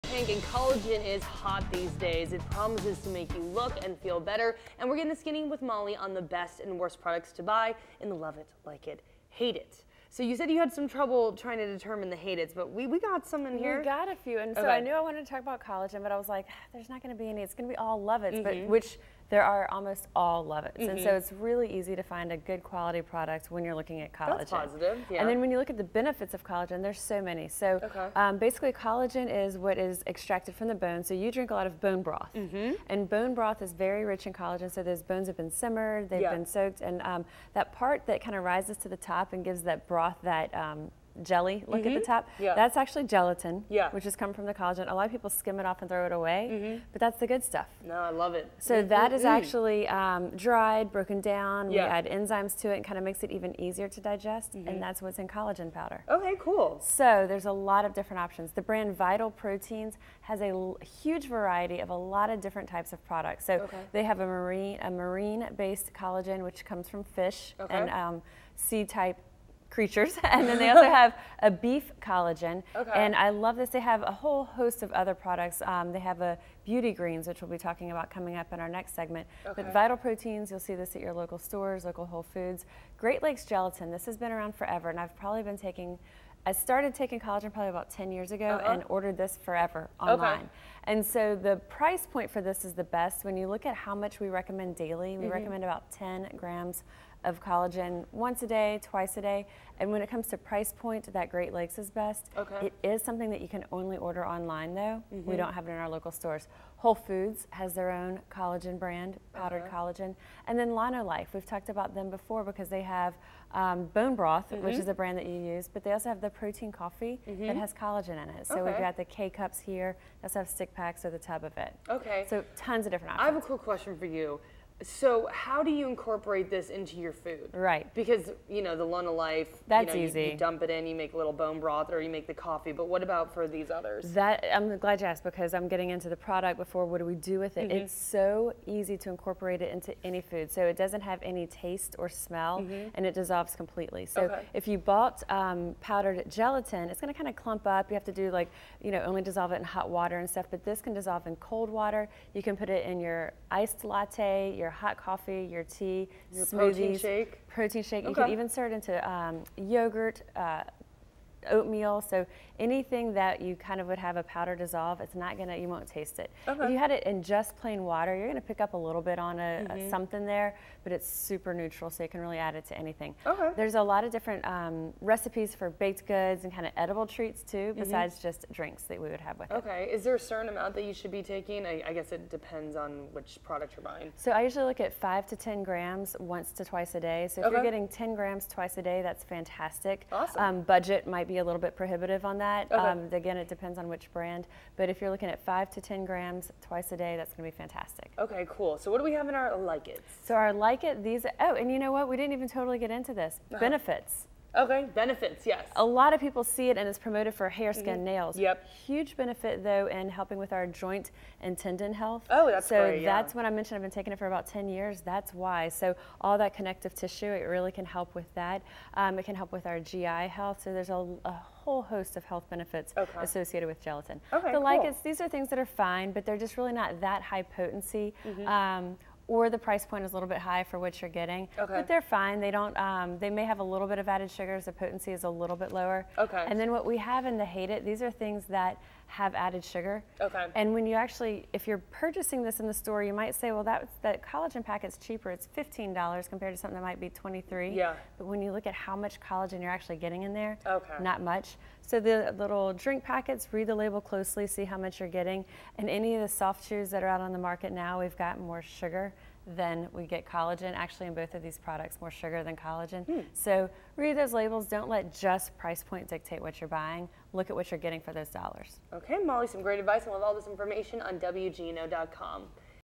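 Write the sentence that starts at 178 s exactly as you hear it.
just drinks that we would have with okay.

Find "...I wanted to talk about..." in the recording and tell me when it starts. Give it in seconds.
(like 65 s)
14 s.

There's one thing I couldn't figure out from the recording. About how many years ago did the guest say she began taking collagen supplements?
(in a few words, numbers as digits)
10 years.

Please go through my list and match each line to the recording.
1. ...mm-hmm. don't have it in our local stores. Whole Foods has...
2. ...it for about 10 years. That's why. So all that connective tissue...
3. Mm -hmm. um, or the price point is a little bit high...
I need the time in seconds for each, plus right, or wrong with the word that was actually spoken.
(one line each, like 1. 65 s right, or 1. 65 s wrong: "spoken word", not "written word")
1. 105 s right
2. 214 s right
3. 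228 s right.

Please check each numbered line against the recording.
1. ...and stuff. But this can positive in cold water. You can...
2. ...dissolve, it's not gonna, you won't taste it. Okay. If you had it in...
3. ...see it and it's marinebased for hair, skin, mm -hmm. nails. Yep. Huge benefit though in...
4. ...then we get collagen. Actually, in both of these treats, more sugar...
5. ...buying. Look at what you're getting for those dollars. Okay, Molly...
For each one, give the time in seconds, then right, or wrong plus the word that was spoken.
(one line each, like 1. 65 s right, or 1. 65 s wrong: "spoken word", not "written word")
1. 150 s wrong: "dissolve", not "positive"
2. 164 s right
3. 206 s wrong: "promoted", not "marinebased"
4. 259 s wrong: "products", not "treats"
5. 266 s right.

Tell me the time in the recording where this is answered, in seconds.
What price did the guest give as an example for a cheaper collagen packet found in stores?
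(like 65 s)
245 s.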